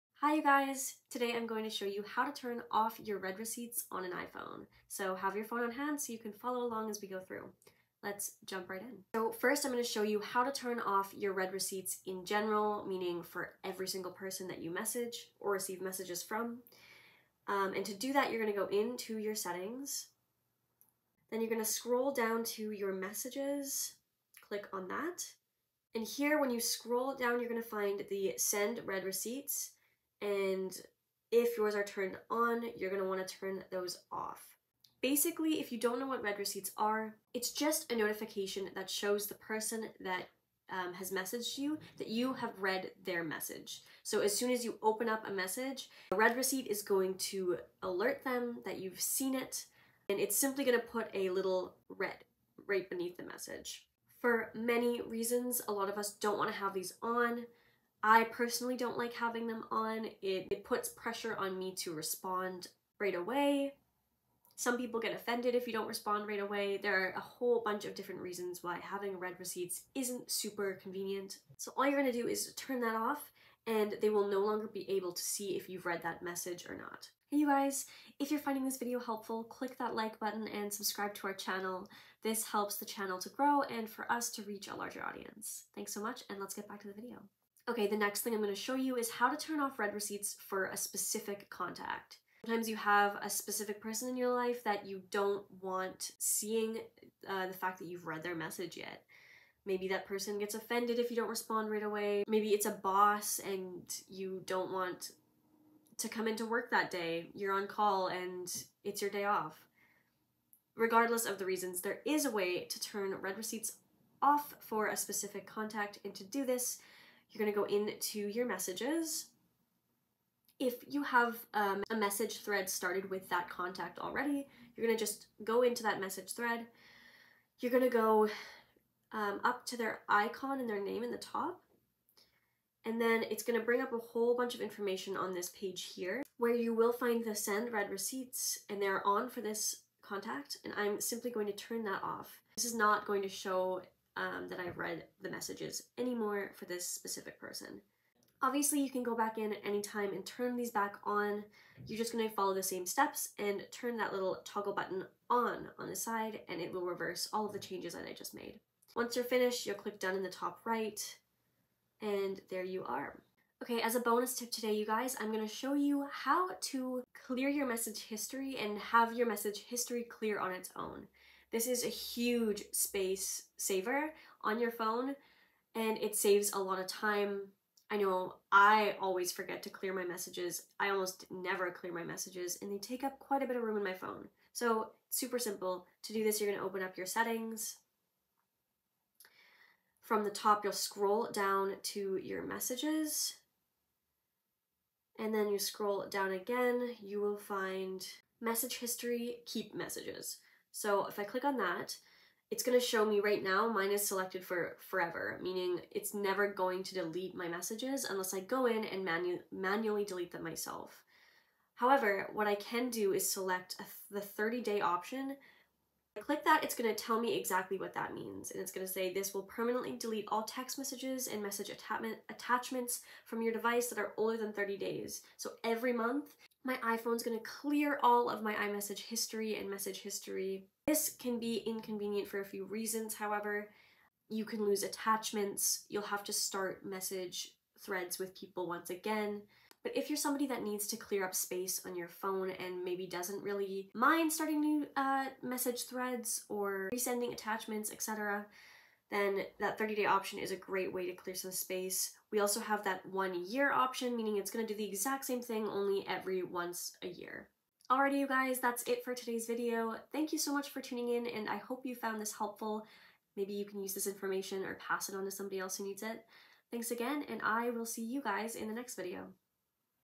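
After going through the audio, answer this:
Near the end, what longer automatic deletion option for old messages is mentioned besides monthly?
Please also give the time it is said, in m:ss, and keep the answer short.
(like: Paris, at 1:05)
one year, at 4:13.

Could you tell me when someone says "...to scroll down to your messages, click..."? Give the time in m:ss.
0:21.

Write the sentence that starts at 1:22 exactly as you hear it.
This helps the channel to grow and for us to reach a larger audience.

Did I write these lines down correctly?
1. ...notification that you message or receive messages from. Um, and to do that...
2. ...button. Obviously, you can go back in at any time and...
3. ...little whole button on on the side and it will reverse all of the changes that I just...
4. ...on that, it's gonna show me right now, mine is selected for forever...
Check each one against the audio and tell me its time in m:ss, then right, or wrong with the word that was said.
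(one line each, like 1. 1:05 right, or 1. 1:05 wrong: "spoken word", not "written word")
1. 0:14 wrong: "person", not "notification"
2. 2:27 wrong: "person", not "button"
3. 2:34 wrong: "toggle", not "whole"
4. 3:21 right.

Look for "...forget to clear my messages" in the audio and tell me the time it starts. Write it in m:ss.
2:59.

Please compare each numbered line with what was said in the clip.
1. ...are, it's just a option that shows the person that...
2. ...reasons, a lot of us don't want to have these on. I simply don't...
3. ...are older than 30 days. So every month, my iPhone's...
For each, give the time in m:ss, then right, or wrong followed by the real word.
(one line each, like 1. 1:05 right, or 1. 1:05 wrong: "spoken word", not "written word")
1. 0:36 wrong: "notification", not "option"
2. 0:55 wrong: "personally", not "simply"
3. 3:43 right.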